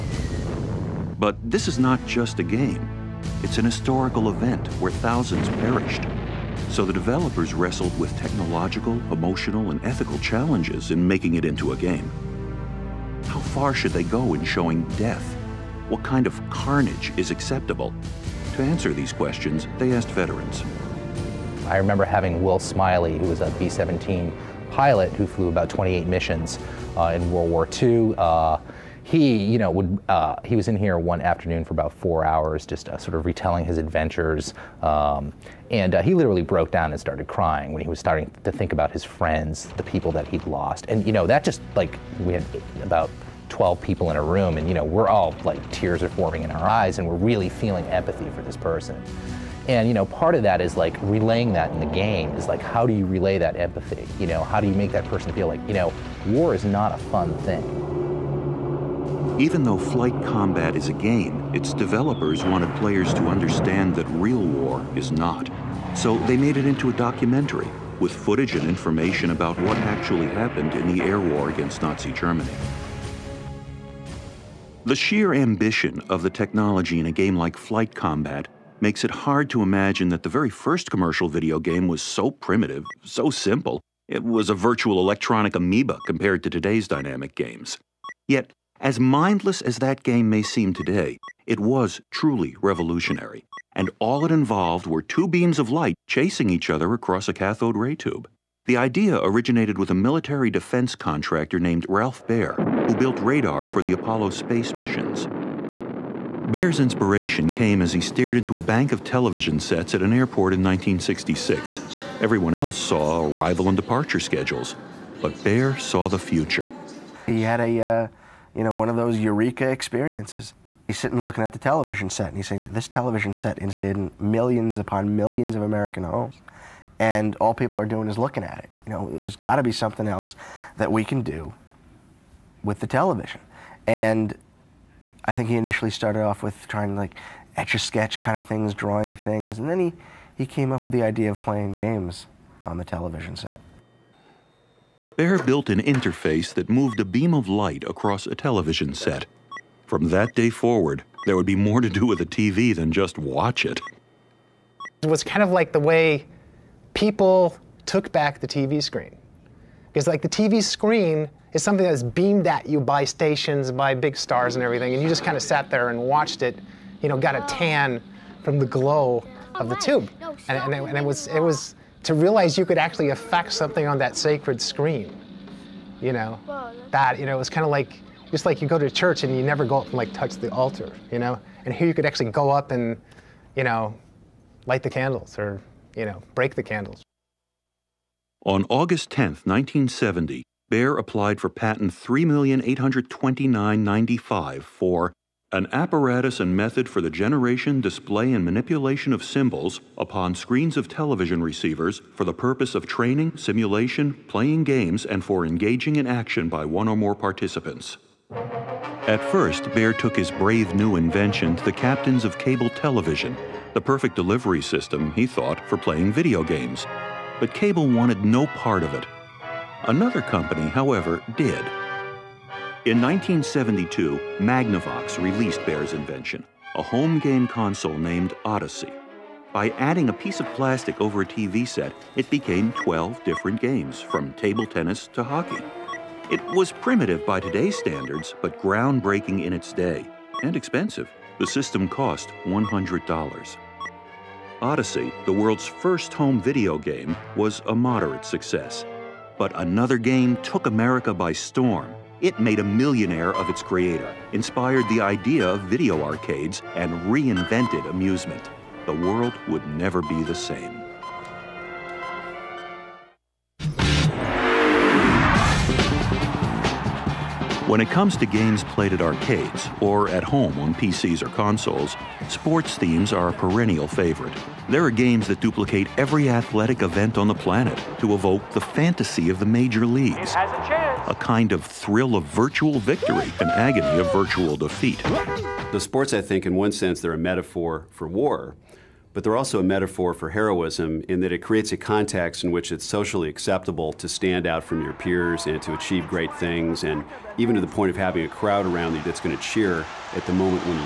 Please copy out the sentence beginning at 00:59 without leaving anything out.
Even though flight combat is a game, its developers wanted players to understand that real war is not.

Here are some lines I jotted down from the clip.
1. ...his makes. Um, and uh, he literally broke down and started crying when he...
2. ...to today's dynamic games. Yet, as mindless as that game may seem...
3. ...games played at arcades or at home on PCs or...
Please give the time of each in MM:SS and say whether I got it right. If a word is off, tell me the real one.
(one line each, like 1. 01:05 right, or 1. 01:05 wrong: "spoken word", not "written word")
1. 00:33 wrong: "adventures", not "makes"
2. 01:26 right
3. 04:28 right.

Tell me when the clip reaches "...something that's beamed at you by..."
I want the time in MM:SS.
02:41.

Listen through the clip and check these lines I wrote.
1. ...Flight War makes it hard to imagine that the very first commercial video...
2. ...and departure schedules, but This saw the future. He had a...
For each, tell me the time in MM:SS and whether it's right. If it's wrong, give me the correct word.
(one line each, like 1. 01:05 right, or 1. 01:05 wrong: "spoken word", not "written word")
1. 01:17 wrong: "Combat", not "War"
2. 01:53 wrong: "Baer", not "This".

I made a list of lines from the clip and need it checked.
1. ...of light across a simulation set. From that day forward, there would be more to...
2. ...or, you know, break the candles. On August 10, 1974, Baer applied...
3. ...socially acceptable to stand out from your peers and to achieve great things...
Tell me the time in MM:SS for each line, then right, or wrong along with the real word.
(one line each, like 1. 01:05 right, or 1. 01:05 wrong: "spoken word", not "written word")
1. 02:27 wrong: "television", not "simulation"
2. 03:05 wrong: "1970", not "1974"
3. 04:52 right.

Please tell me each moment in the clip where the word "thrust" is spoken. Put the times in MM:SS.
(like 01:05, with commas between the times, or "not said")
not said.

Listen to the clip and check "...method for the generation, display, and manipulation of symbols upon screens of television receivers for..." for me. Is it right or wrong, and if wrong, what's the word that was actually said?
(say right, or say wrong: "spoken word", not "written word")
right.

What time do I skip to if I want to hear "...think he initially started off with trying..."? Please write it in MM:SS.
02:15.